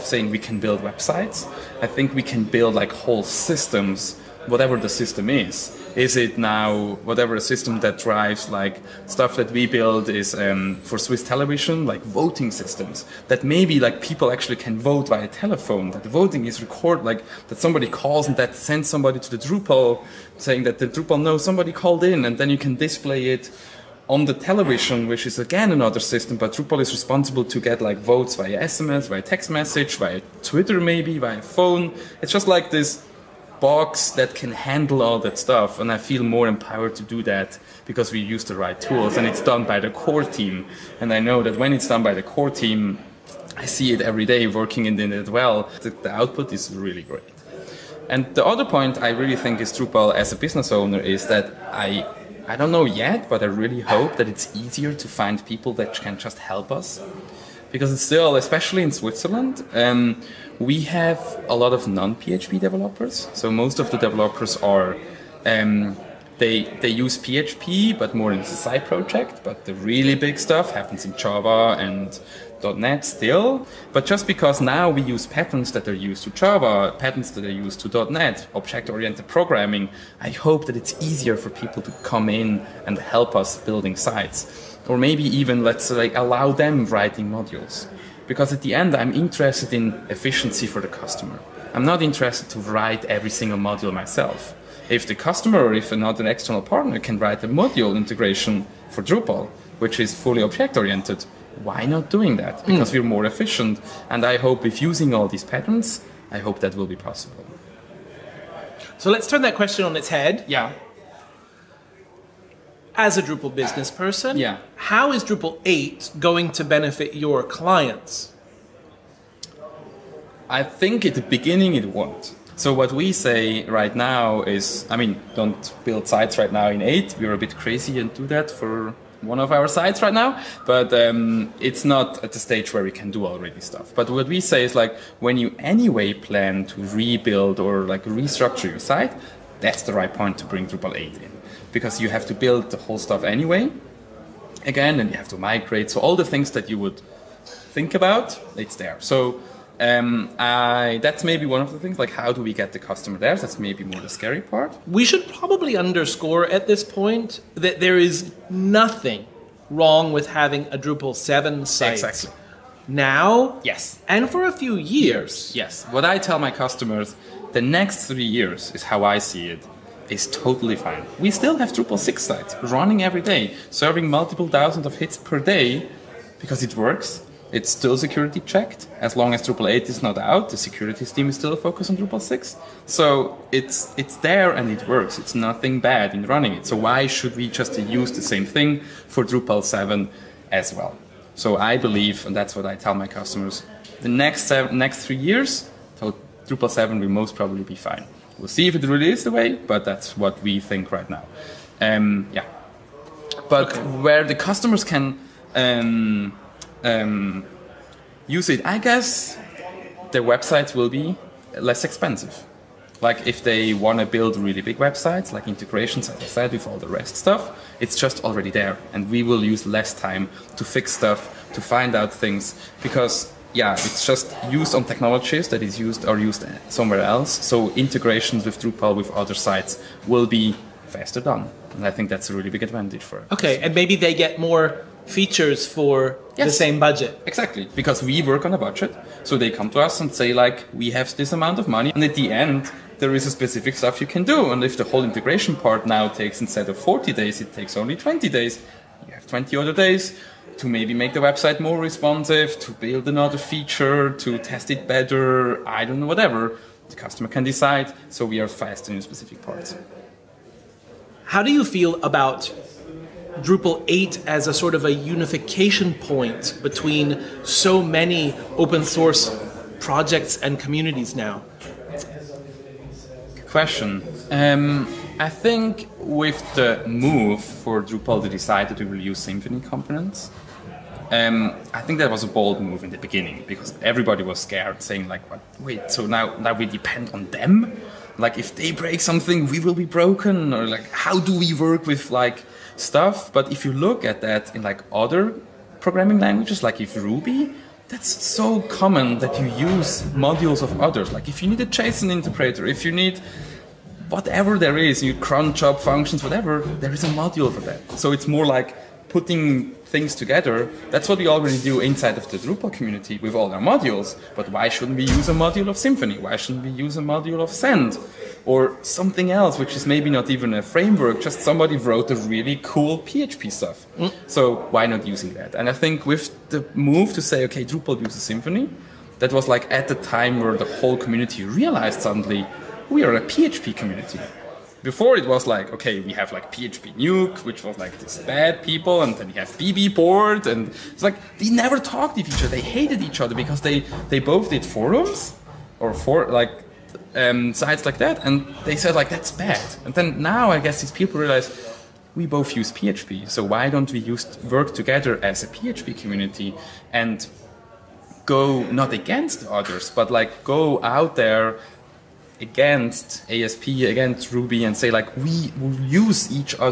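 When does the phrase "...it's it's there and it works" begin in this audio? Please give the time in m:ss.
3:03.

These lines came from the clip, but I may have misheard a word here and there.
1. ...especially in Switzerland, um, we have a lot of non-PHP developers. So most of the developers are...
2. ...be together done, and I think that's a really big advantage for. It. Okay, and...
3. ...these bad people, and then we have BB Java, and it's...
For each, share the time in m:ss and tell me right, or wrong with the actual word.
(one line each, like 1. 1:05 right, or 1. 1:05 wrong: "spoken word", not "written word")
1. 0:58 right
2. 3:50 wrong: "faster", not "together"
3. 5:38 wrong: "Board", not "Java".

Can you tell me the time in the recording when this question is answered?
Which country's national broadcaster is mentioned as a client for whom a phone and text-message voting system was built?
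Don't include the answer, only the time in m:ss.
0:10.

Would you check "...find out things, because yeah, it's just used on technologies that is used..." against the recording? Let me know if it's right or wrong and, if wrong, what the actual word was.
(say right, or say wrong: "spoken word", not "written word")
right.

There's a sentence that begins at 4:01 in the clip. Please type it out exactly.
And at the end, there is a specific stuff you can do.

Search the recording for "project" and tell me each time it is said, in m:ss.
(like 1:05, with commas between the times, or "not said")
1:08, 4:29.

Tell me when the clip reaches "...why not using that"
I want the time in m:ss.
5:24.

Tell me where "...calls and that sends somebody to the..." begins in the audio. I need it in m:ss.
0:17.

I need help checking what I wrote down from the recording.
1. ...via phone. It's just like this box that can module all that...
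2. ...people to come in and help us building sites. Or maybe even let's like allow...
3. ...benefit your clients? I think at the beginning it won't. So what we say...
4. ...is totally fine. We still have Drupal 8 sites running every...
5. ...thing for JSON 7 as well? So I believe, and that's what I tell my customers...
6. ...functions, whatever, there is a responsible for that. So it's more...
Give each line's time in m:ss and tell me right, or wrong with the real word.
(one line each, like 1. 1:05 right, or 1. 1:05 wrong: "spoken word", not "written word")
1. 0:31 wrong: "handle", not "module"
2. 1:21 right
3. 1:56 right
4. 2:50 wrong: "6", not "8"
5. 3:08 wrong: "Drupal", not "JSON"
6. 5:05 wrong: "module", not "responsible".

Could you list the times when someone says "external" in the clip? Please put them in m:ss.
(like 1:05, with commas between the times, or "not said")
1:36.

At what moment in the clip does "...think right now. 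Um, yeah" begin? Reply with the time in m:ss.
3:20.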